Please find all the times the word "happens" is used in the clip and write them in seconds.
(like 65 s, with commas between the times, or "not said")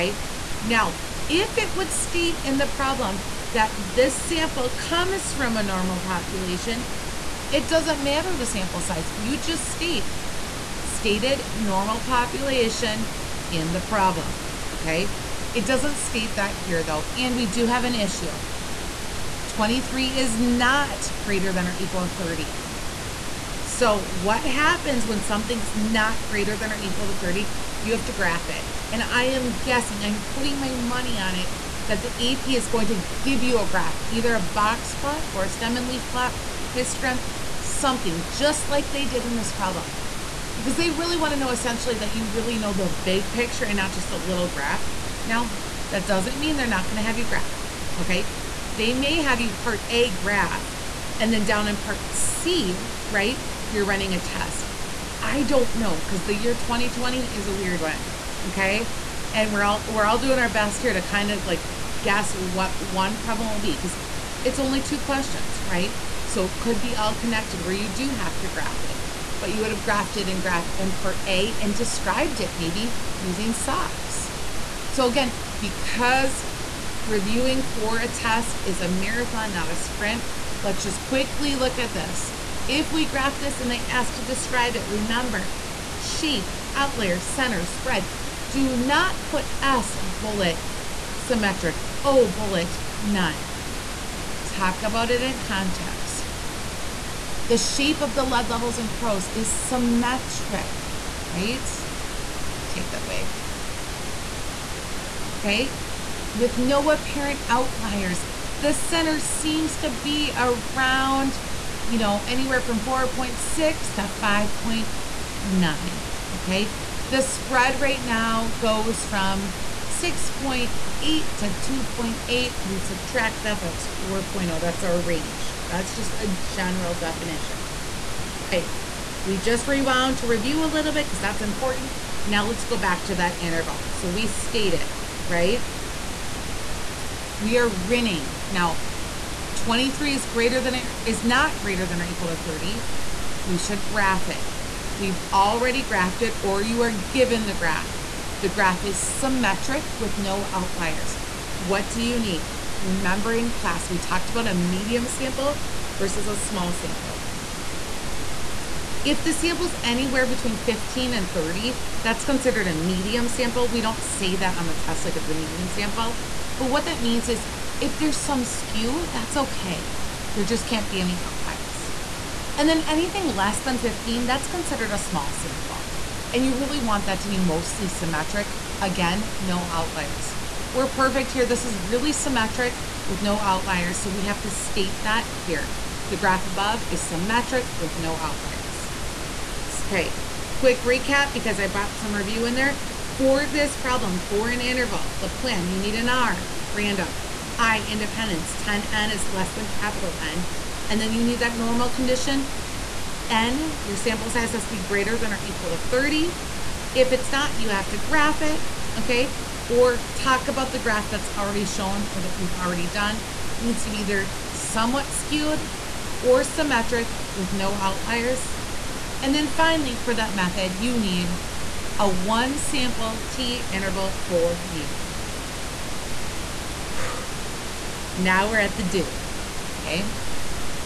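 24 s.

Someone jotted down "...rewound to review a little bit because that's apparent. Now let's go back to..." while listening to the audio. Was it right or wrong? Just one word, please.
wrong.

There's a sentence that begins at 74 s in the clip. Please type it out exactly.
So again, because reviewing for a test is a marathon, not a sprint, let's just quickly look at this.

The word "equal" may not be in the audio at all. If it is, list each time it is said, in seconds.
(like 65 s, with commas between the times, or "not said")
21 s, 26 s, 142 s, 205 s.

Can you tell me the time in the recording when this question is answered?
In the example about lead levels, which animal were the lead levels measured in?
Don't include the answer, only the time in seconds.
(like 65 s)
98 s.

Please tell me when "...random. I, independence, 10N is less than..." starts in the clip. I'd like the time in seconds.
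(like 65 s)
196 s.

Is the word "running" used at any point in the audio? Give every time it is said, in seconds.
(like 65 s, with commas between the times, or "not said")
53 s.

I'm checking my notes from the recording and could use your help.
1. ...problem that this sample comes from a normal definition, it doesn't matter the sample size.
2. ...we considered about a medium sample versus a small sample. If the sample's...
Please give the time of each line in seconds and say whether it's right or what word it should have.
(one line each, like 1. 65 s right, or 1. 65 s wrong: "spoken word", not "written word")
1. 2 s wrong: "population", not "definition"
2. 153 s wrong: "talked", not "considered".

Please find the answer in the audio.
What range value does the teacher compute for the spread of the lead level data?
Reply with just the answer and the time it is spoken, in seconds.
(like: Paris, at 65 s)
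4.0, at 124 s.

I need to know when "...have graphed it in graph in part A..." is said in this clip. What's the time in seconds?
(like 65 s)
69 s.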